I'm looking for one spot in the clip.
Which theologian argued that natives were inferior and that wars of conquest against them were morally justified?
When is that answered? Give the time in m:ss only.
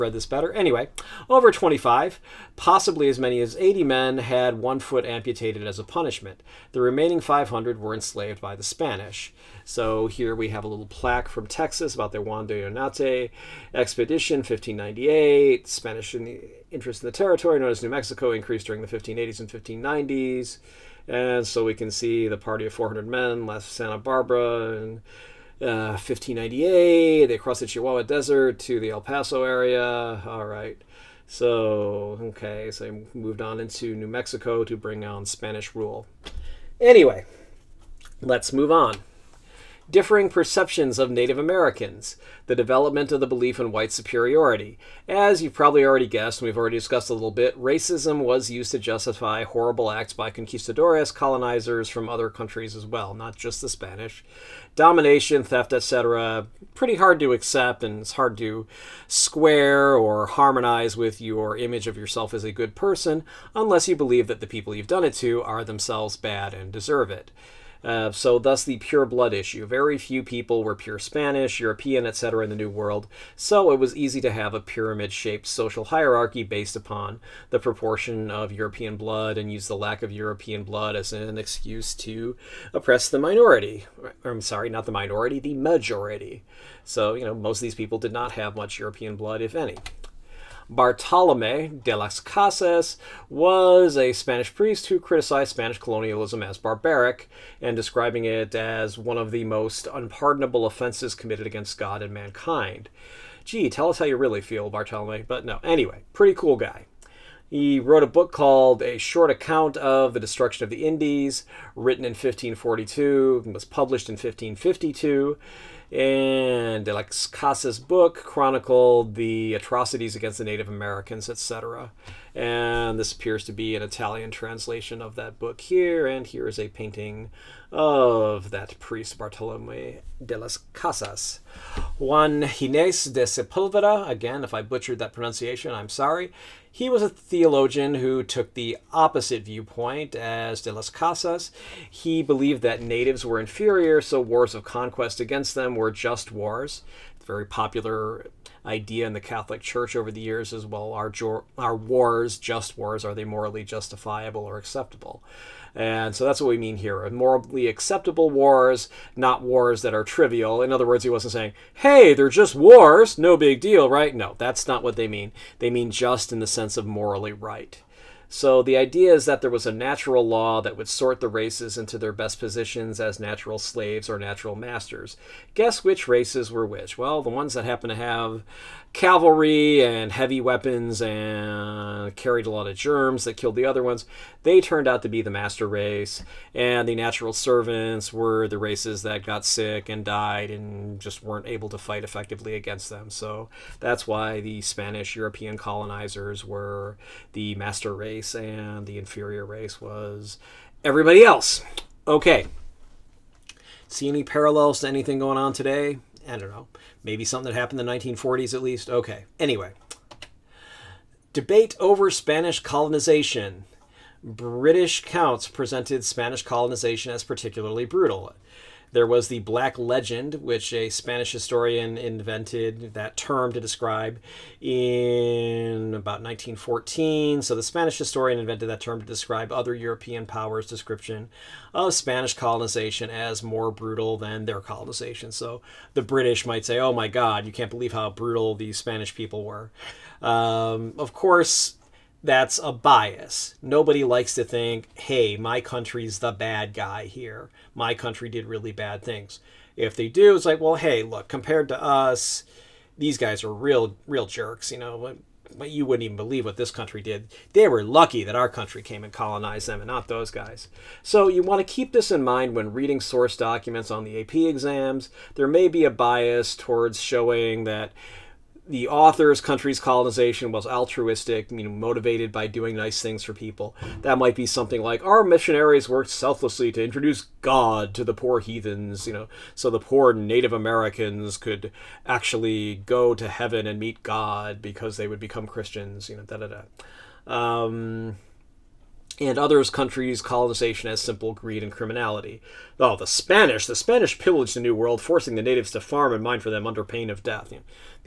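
2:11.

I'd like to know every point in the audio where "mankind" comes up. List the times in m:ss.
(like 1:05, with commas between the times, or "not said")
1:42.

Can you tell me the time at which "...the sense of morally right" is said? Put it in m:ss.
2:46.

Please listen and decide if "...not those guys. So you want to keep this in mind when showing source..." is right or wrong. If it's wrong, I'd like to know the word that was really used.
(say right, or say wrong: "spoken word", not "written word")
wrong: "reading", not "showing".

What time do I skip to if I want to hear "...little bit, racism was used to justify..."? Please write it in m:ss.
0:47.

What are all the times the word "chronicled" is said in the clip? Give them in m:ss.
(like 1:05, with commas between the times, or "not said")
1:58.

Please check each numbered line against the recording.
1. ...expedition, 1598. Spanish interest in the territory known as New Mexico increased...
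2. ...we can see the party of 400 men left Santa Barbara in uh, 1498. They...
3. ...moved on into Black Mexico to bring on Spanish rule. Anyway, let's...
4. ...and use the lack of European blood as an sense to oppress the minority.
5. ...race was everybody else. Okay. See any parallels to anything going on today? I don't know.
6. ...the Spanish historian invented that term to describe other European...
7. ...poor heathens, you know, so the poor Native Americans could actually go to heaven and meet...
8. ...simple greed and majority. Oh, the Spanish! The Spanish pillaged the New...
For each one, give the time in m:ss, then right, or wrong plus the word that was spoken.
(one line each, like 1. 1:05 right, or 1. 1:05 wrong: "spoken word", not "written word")
1. 0:13 right
2. 0:21 wrong: "1598", not "1498"
3. 0:33 wrong: "New", not "Black"
4. 1:19 wrong: "excuse", not "sense"
5. 3:19 right
6. 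3:47 right
7. 4:38 right
8. 4:50 wrong: "criminality", not "majority".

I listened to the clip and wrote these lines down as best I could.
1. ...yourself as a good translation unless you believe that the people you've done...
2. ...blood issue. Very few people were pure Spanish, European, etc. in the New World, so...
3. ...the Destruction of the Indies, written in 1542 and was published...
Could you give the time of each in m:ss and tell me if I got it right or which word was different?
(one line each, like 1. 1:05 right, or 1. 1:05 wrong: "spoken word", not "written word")
1. 1:01 wrong: "person", not "translation"
2. 1:09 right
3. 1:50 right.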